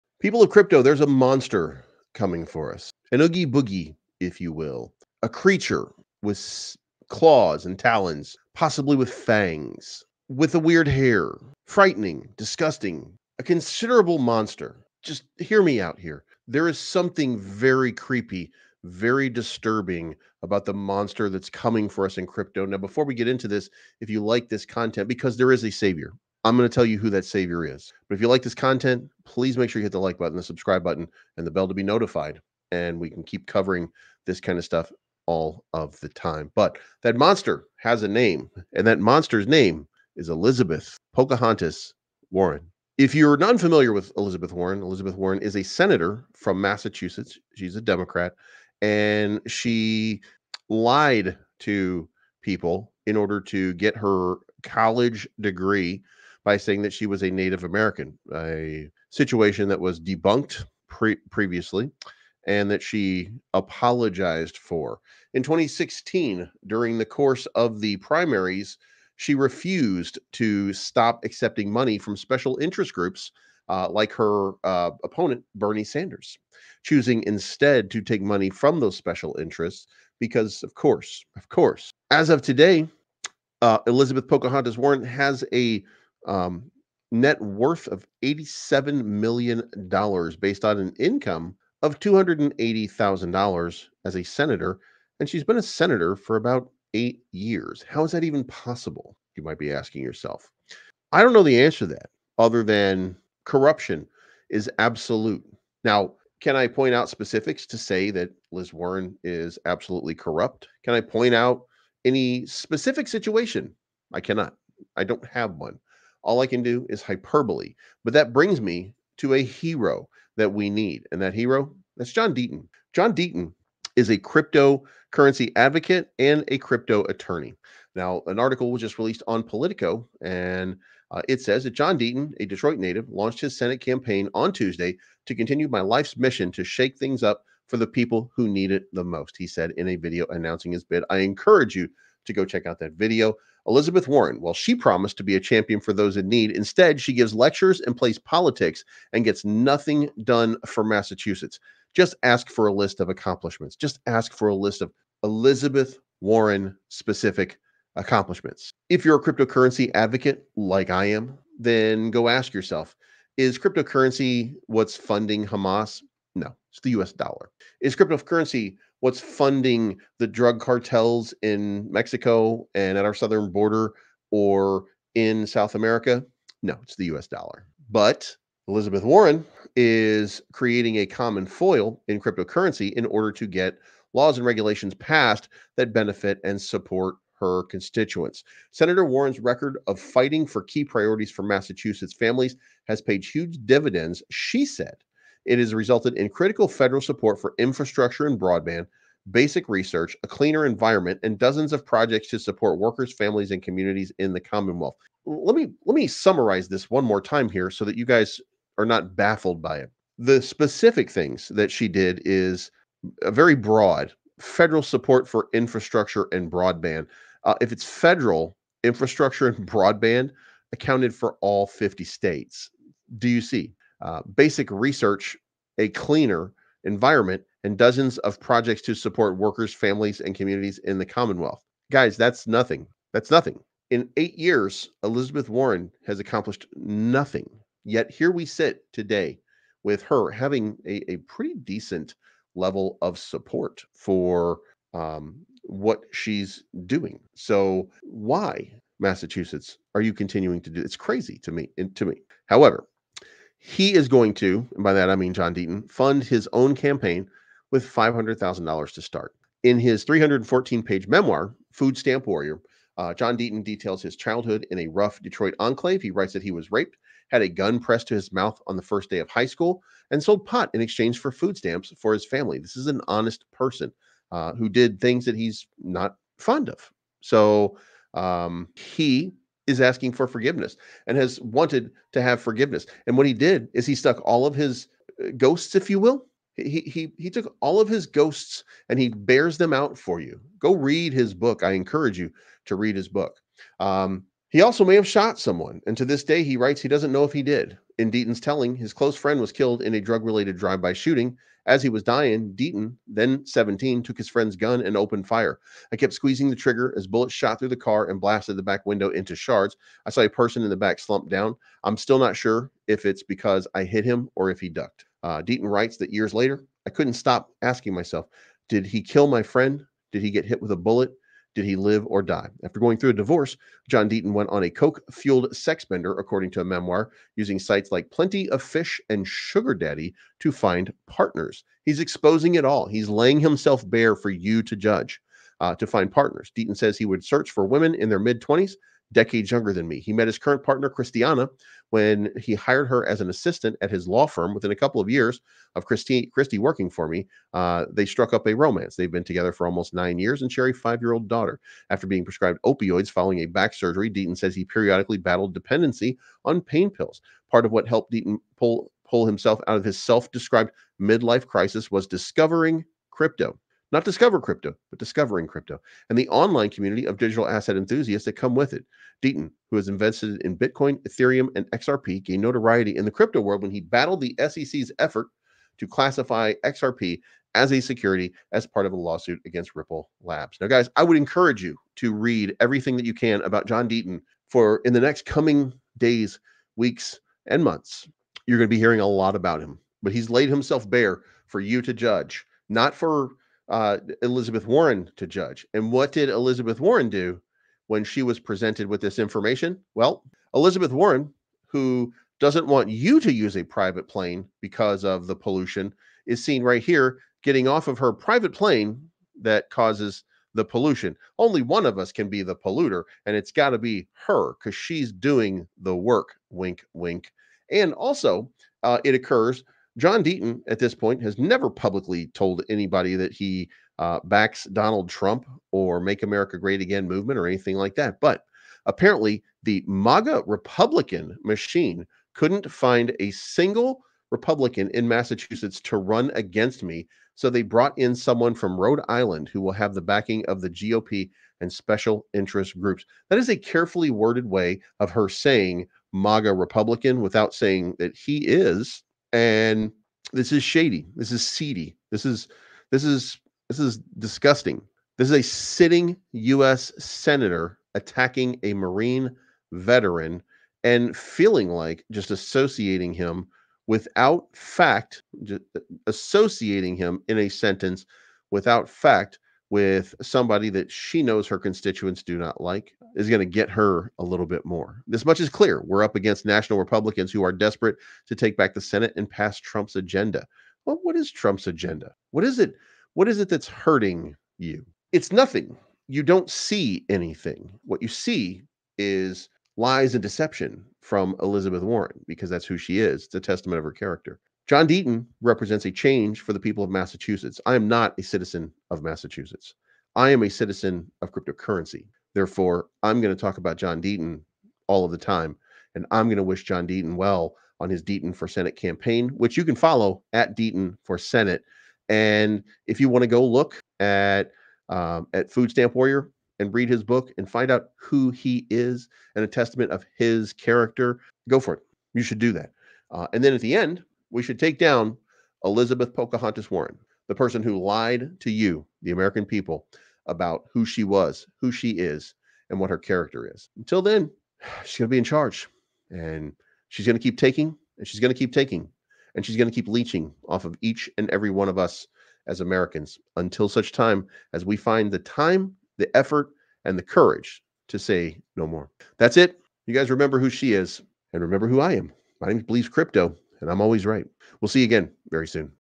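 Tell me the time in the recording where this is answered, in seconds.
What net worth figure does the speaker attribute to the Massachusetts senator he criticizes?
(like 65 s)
88 s.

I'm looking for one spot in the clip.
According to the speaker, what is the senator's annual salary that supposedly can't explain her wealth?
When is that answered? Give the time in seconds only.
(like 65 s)
91 s.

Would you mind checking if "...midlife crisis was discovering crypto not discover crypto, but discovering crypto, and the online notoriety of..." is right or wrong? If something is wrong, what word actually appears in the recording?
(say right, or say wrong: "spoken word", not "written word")
wrong: "community", not "notoriety".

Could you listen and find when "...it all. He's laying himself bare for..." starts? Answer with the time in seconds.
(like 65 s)
332 s.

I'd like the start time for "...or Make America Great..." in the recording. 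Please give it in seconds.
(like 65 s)
425 s.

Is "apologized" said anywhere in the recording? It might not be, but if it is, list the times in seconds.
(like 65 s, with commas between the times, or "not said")
63 s.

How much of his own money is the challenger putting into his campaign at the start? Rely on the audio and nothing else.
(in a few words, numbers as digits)
$500,000.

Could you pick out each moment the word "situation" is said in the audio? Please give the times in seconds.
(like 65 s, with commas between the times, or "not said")
59 s, 113 s.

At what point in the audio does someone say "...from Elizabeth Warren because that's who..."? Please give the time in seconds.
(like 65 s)
490 s.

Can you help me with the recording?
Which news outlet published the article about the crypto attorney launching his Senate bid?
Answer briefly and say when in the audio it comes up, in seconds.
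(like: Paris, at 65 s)
Politico, at 129 s.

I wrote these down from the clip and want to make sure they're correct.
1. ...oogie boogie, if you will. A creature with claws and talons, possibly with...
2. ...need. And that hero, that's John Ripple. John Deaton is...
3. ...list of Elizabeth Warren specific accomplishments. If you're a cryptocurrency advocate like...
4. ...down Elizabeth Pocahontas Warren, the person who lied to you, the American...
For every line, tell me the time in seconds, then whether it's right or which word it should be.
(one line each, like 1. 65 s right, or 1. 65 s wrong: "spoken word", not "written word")
1. 3 s right
2. 120 s wrong: "Deaton", not "Ripple"
3. 154 s right
4. 524 s right.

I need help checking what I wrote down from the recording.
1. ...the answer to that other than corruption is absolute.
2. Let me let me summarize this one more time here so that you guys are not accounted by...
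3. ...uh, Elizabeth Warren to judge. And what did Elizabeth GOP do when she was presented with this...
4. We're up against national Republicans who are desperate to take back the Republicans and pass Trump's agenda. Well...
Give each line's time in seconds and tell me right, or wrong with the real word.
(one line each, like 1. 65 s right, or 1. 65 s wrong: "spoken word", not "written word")
1. 101 s right
2. 205 s wrong: "baffled", not "accounted"
3. 393 s wrong: "Warren", not "GOP"
4. 475 s wrong: "Senate", not "Republicans".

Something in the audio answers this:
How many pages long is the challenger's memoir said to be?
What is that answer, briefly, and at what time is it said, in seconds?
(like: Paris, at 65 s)
314, at 260 s.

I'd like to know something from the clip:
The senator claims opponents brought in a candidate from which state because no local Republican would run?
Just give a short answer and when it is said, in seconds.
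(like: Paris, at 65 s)
Rhode Island, at 438 s.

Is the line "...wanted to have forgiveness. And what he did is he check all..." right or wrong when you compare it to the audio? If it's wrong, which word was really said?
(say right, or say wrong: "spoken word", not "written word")
wrong: "stuck", not "check".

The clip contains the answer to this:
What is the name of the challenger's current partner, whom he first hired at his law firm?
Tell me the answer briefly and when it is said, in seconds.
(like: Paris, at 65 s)
Christiana, at 340 s.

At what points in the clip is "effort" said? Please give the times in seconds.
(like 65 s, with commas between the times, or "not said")
374 s, 546 s.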